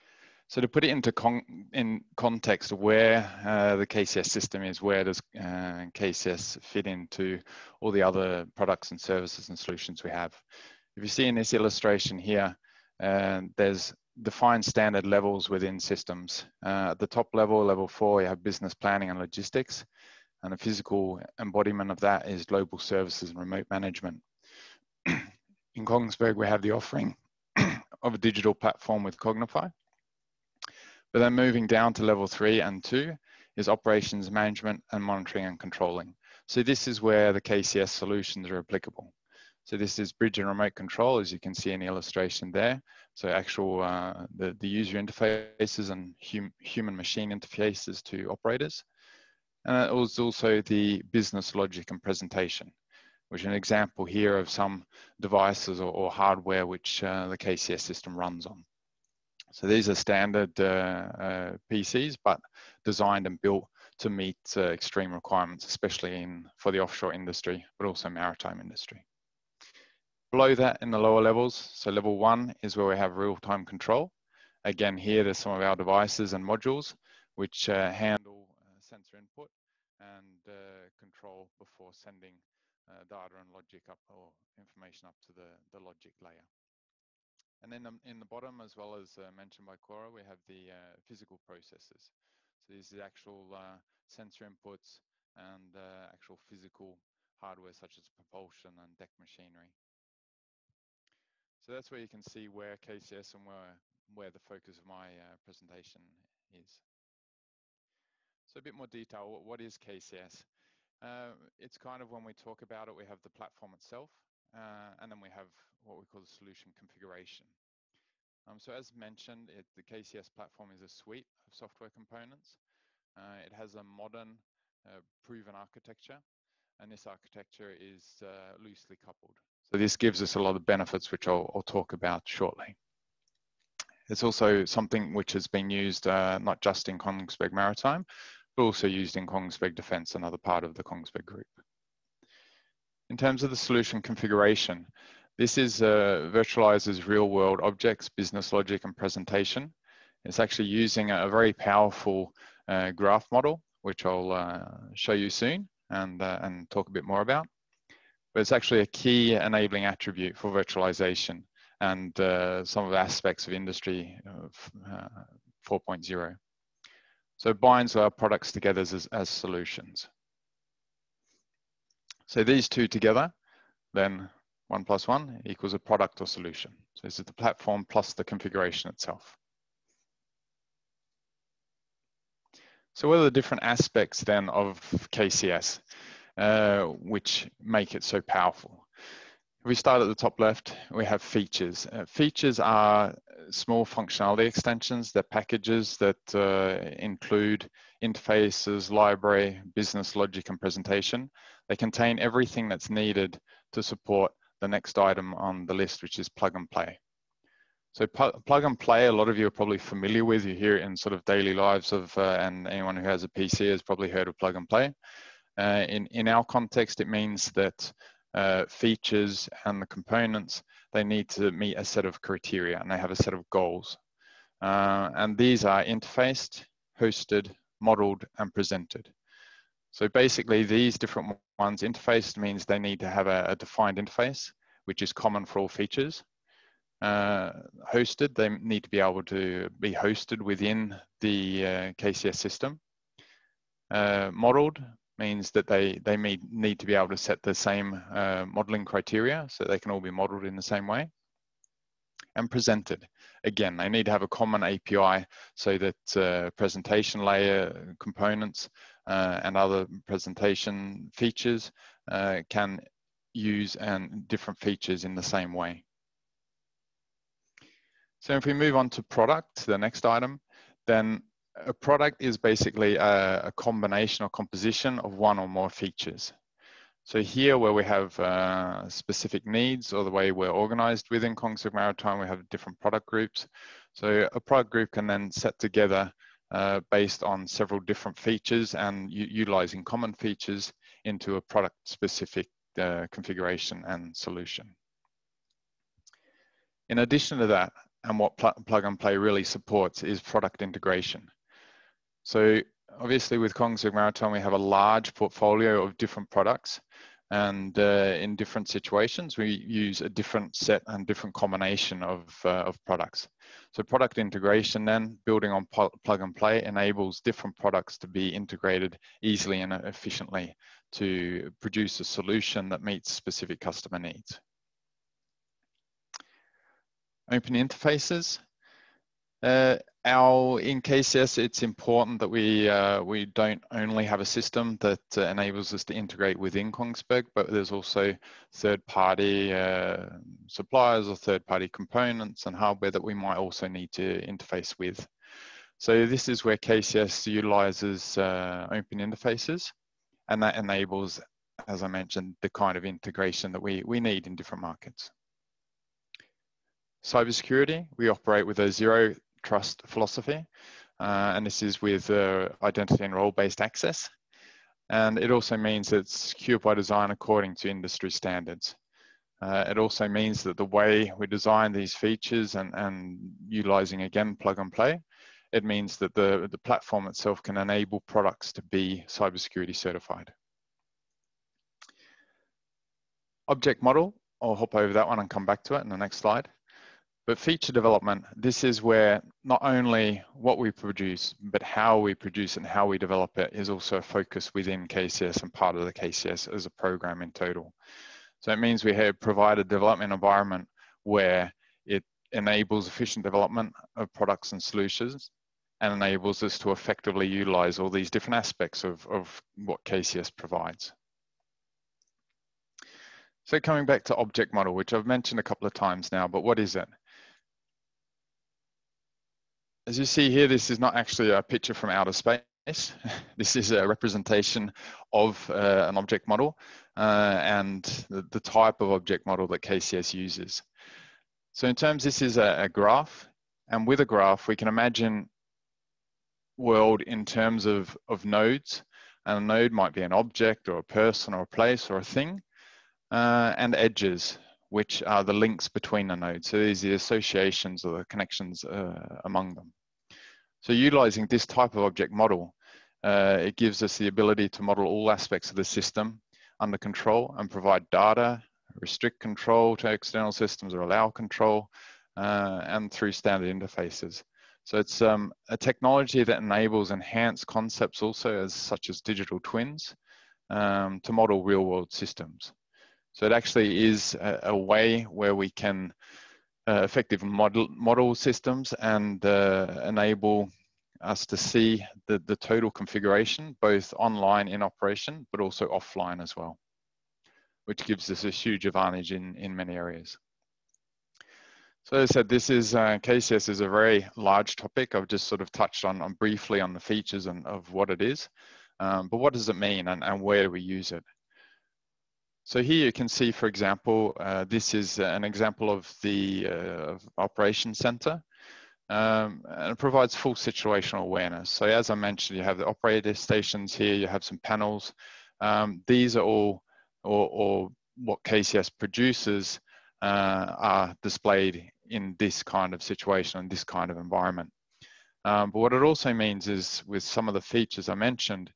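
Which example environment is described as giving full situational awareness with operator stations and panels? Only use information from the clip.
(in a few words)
operation center.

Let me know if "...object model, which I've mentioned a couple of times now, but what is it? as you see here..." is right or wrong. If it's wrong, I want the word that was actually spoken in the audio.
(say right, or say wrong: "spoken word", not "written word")
right.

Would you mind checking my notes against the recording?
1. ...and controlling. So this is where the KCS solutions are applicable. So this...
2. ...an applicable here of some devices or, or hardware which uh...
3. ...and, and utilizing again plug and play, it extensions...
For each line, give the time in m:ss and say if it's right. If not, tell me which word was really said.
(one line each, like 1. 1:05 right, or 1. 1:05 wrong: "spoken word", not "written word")
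1. 0:35 right
2. 0:53 wrong: "example", not "applicable"
3. 6:12 wrong: "means", not "extensions".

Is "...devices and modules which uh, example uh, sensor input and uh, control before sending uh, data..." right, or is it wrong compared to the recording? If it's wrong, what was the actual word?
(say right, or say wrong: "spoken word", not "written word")
wrong: "handle", not "example".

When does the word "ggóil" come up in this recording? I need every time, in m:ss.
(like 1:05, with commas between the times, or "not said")
not said.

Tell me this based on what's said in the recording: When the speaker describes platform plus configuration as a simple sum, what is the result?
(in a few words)
a product or solution.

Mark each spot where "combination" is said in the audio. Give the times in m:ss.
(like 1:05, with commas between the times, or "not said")
4:33, 5:11.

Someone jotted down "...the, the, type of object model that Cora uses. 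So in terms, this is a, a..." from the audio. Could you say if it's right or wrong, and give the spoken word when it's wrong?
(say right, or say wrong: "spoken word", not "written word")
wrong: "KCS", not "Cora".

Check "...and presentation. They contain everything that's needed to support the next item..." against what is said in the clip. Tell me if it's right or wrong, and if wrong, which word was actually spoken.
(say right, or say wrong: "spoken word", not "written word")
right.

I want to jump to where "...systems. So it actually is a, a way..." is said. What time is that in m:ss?
7:51.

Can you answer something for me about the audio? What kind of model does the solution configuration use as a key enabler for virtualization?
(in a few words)
graph model.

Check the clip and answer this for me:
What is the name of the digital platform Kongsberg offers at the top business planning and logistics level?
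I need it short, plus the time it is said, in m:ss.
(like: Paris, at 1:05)
Cognify, at 0:29.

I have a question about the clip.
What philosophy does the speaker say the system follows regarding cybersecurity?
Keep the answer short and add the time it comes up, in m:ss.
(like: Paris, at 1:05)
zero trust, at 5:58.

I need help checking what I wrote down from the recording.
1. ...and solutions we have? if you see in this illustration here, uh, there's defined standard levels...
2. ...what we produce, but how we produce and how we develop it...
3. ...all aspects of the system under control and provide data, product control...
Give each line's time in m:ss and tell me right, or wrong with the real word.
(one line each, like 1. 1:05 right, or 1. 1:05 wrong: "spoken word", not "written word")
1. 0:09 right
2. 6:30 right
3. 7:34 wrong: "restrict", not "product".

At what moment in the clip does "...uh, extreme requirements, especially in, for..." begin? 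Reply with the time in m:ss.
1:04.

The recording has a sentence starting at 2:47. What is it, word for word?
So it binds our products together as, as solutions.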